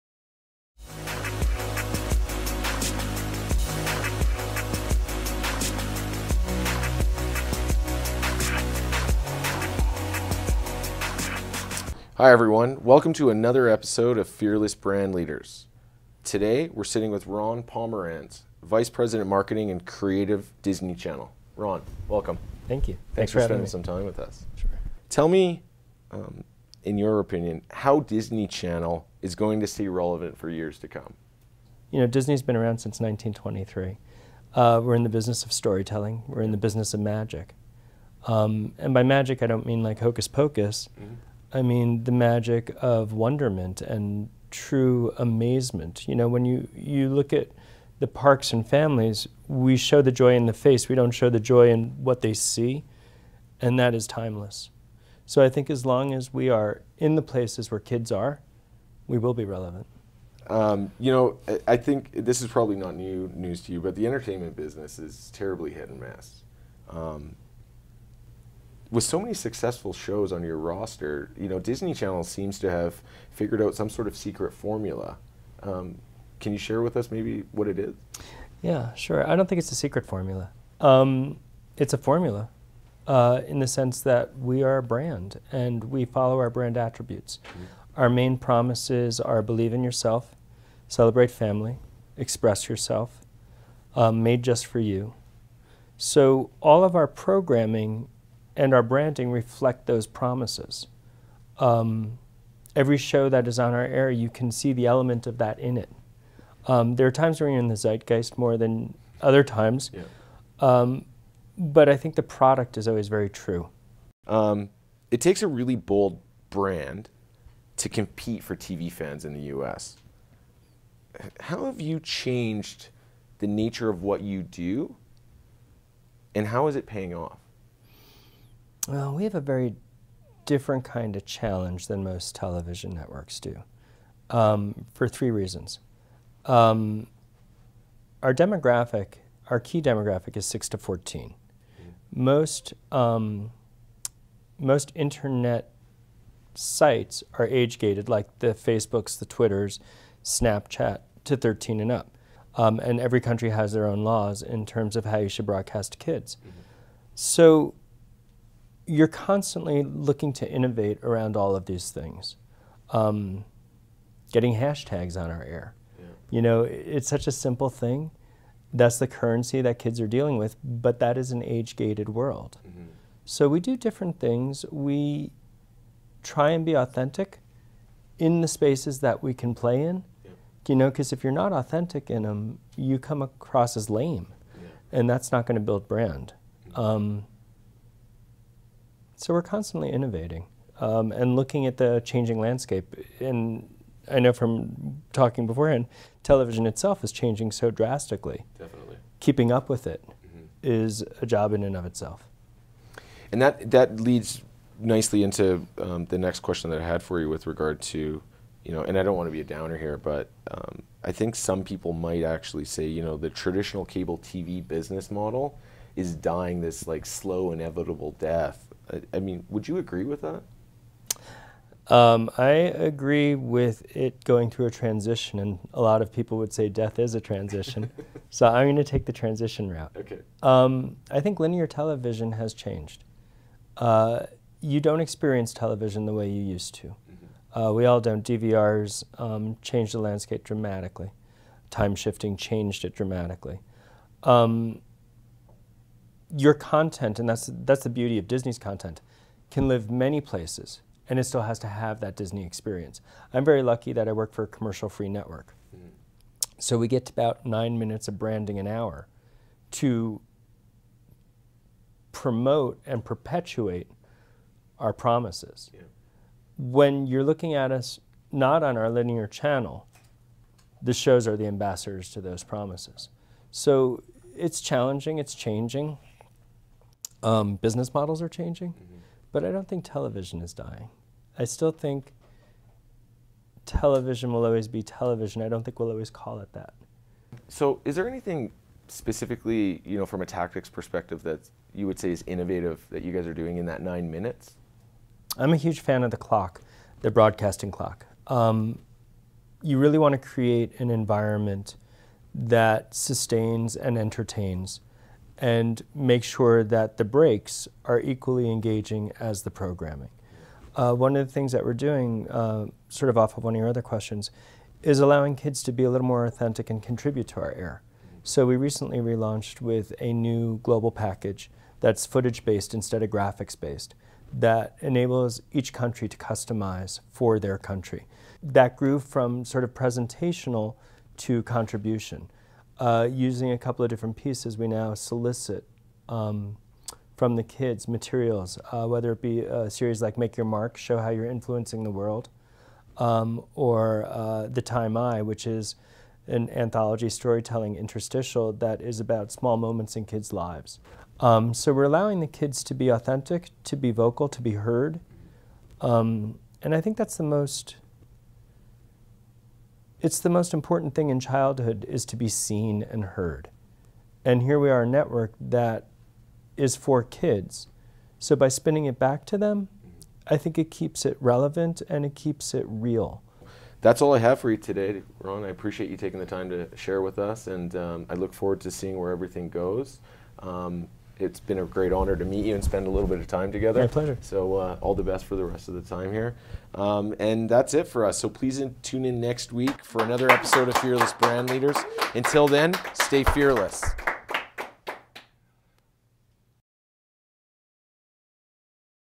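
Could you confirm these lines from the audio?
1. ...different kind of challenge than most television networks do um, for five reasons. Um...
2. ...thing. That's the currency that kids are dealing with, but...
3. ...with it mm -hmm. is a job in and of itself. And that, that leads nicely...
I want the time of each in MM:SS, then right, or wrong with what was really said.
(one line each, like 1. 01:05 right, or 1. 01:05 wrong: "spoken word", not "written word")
1. 02:10 wrong: "three", not "five"
2. 02:47 right
3. 03:19 right.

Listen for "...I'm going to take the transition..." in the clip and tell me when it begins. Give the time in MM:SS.
03:48.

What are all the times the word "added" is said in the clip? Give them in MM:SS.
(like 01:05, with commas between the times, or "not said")
not said.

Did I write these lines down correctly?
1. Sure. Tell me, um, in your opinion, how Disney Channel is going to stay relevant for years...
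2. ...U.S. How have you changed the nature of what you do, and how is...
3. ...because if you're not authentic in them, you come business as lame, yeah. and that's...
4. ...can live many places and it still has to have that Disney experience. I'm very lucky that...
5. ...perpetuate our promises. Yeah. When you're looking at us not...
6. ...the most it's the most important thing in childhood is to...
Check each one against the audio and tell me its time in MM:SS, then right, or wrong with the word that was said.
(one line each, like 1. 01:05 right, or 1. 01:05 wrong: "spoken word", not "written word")
1. 00:24 right
2. 01:59 right
3. 03:00 wrong: "across", not "business"
4. 04:09 right
5. 04:23 right
6. 05:57 right.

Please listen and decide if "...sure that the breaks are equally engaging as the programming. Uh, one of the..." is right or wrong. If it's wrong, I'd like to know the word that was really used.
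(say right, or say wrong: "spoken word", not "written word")
right.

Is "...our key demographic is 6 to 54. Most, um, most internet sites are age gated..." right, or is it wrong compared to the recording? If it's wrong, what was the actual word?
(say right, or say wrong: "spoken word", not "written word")
wrong: "14", not "54".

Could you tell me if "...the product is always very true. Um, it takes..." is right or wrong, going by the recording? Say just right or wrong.
right.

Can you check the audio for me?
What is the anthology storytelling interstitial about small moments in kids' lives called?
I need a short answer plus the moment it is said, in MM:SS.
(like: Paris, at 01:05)
The Time I, at 05:44.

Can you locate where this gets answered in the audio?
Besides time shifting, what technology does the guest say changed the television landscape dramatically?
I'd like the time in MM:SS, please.
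03:58.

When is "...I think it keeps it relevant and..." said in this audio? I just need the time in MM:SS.
06:10.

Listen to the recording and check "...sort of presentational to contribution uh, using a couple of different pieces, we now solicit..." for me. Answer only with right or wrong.
right.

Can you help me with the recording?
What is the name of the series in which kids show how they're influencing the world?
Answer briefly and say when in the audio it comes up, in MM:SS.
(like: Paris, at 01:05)
Make Your Mark, at 05:40.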